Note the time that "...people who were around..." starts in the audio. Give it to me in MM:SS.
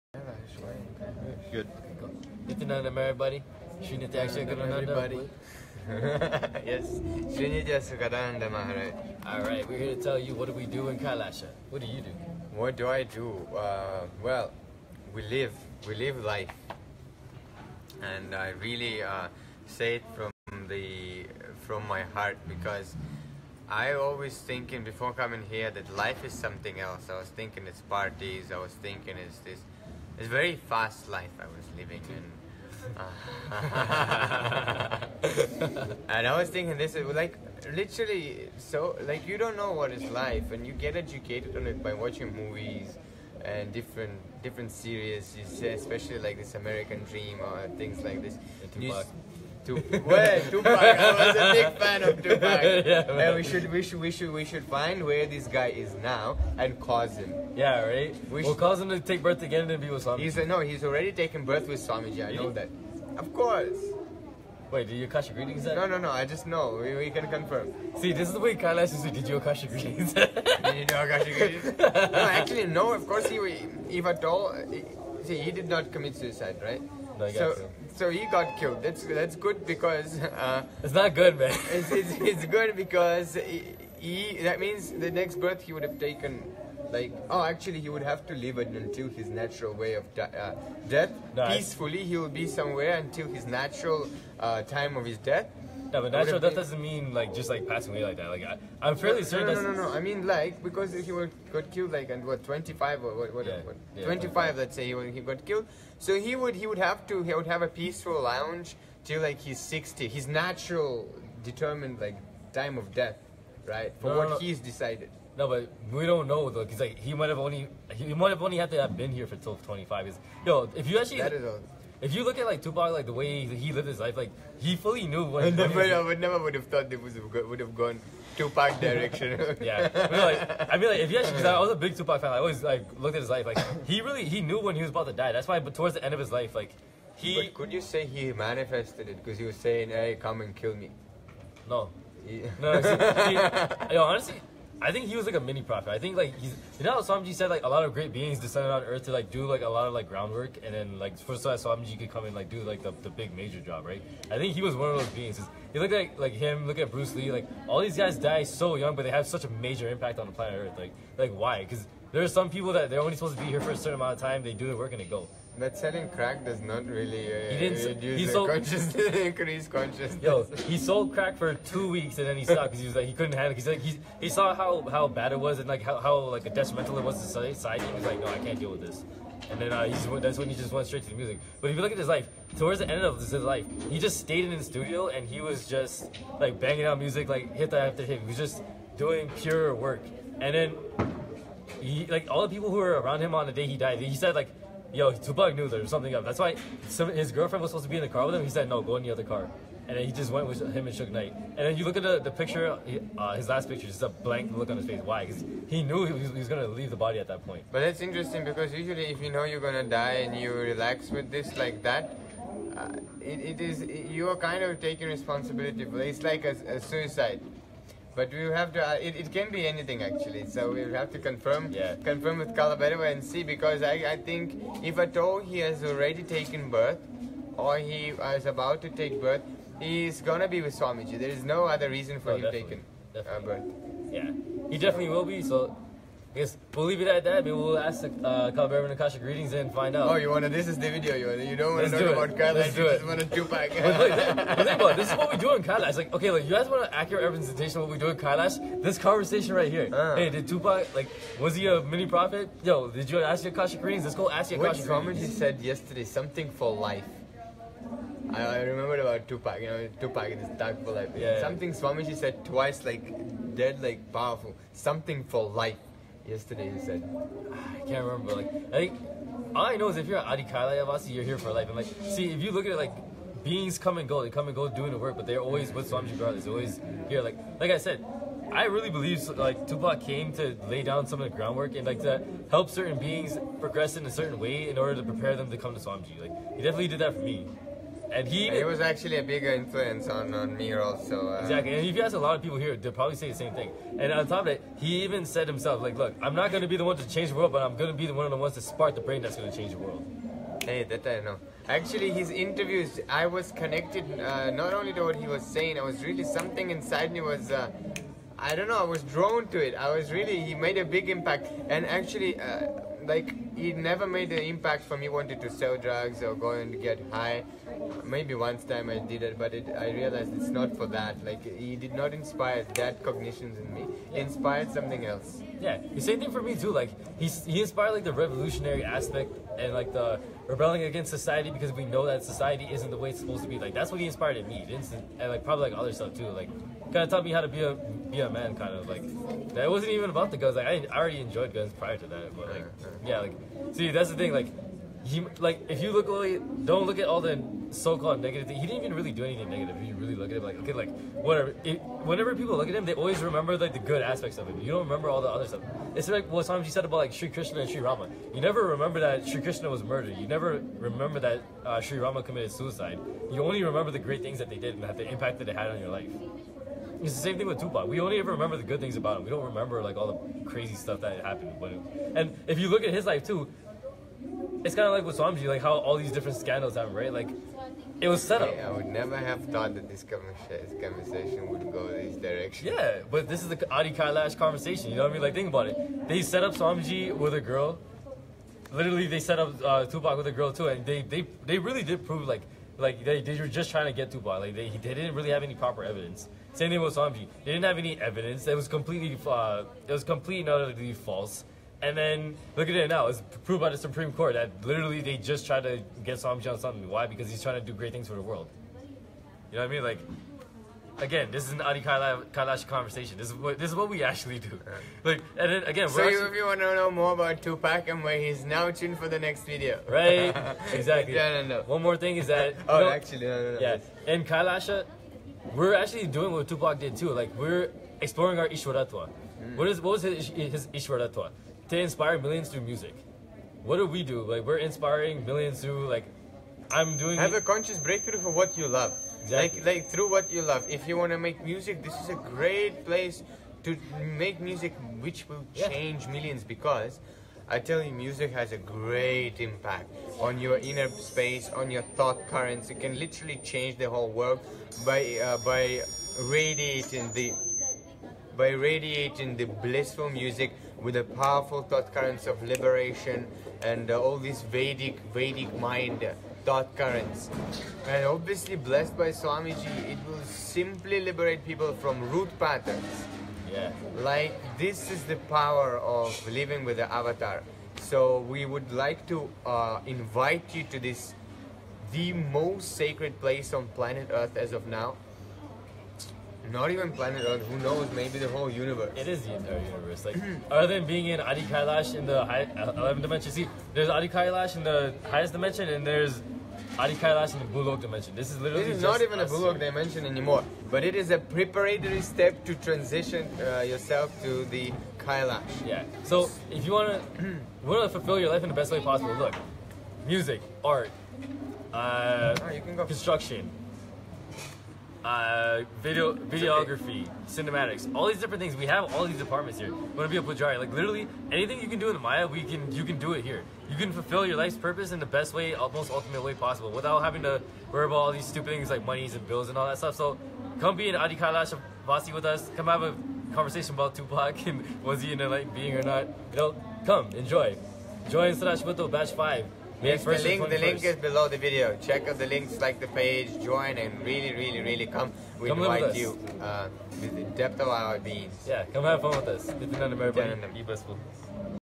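03:12.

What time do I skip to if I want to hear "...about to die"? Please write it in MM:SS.
02:14.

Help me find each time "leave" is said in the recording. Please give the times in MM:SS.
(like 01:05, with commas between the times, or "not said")
03:26, 03:56.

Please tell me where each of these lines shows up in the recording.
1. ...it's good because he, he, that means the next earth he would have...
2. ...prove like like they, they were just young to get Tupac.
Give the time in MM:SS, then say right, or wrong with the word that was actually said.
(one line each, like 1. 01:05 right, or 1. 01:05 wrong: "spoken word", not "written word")
1. 01:22 wrong: "birth", not "earth"
2. 06:32 wrong: "trying", not "young".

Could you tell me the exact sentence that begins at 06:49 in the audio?
Like, again, this is an Adi Kailash conversation.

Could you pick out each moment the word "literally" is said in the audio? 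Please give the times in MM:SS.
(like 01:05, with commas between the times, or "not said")
00:37, 06:28, 06:44, 07:32, 08:18, 08:40.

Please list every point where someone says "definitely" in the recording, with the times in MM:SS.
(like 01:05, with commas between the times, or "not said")
03:54, 04:46.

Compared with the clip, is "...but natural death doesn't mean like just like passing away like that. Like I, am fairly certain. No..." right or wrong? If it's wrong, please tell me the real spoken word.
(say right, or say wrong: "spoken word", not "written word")
right.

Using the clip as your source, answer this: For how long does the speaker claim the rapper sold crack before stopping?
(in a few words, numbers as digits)
two weeks.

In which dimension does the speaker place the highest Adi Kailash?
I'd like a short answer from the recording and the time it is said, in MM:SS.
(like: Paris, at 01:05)
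11th, at 08:12.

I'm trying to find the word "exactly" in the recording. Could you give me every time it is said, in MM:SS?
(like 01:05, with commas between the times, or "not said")
04:51, 07:00, 07:19.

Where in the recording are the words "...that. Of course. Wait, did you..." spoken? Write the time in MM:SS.
01:02.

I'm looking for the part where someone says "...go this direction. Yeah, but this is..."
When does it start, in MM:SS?
06:21.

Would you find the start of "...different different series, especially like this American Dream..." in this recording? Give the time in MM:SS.
00:43.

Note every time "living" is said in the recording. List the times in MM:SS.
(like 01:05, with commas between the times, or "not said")
00:31, 07:56.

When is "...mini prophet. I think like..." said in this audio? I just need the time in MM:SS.
02:25.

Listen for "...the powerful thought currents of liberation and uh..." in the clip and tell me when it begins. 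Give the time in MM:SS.
07:40.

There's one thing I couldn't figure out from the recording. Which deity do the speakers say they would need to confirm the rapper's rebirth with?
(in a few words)
Kalabhairava.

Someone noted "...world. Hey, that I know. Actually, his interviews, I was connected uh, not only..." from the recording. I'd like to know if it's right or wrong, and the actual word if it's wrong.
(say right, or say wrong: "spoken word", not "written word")
right.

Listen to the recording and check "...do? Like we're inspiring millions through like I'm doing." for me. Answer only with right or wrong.
right.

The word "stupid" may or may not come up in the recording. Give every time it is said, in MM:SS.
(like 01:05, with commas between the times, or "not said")
08:48.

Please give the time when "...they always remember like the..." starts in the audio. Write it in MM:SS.
05:52.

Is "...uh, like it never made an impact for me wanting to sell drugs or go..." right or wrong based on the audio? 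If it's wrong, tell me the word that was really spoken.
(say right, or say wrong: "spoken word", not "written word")
right.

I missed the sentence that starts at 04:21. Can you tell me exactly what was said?
Yeah, Something Swamiji said twice, like dead, like powerful.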